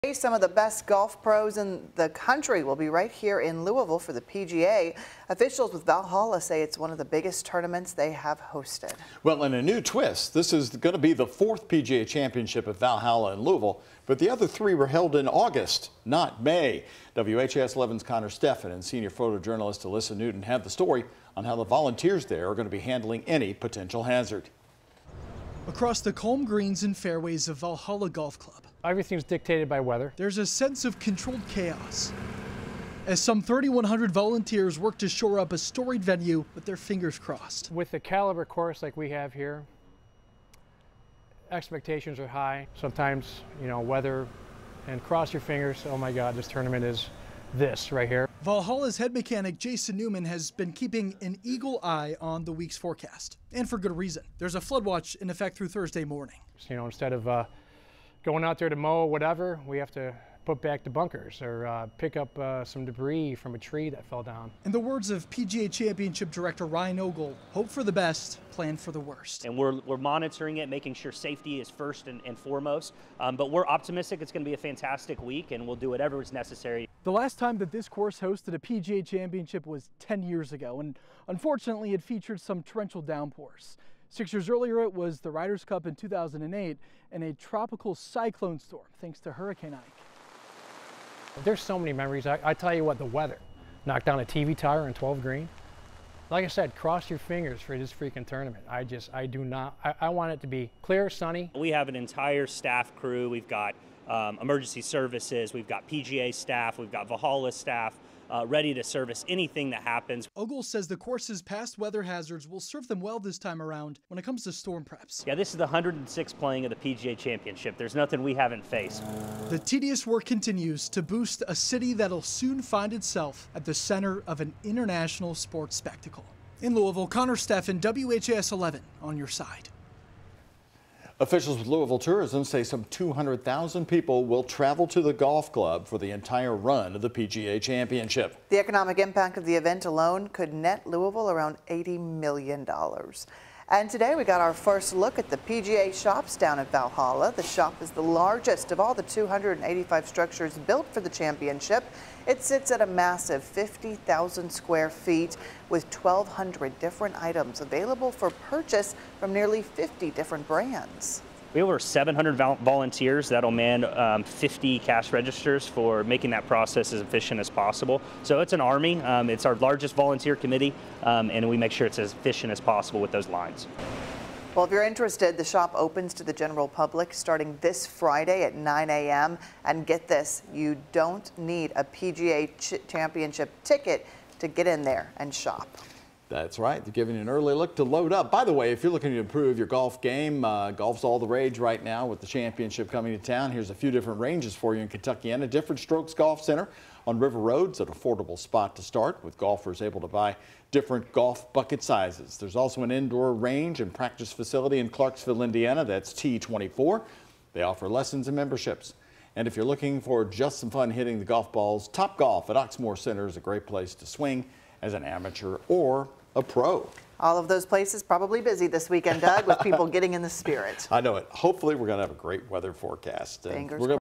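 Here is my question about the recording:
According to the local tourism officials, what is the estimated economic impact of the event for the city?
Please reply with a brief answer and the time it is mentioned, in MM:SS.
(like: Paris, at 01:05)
$80 million, at 02:21.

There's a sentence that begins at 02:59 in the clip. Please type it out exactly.
And get this, you don't need a PGA Championship ticket to get in there and shop.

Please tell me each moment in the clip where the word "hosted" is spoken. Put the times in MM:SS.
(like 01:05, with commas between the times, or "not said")
00:08, 01:18.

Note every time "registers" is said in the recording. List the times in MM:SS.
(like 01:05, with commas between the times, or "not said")
02:45.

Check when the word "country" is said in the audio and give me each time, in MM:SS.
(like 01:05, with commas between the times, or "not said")
00:02.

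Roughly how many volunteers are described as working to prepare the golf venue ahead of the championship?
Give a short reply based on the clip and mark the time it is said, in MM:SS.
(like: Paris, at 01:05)
3,100, at 00:33.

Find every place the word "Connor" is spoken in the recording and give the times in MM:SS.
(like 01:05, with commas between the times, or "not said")
00:18, 02:07.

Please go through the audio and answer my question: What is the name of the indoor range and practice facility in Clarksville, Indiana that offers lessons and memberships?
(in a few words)
T24.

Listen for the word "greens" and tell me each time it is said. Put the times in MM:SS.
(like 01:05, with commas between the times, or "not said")
00:26, 01:35.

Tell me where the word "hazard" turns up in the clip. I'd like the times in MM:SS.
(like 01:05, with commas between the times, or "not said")
00:24, 01:52.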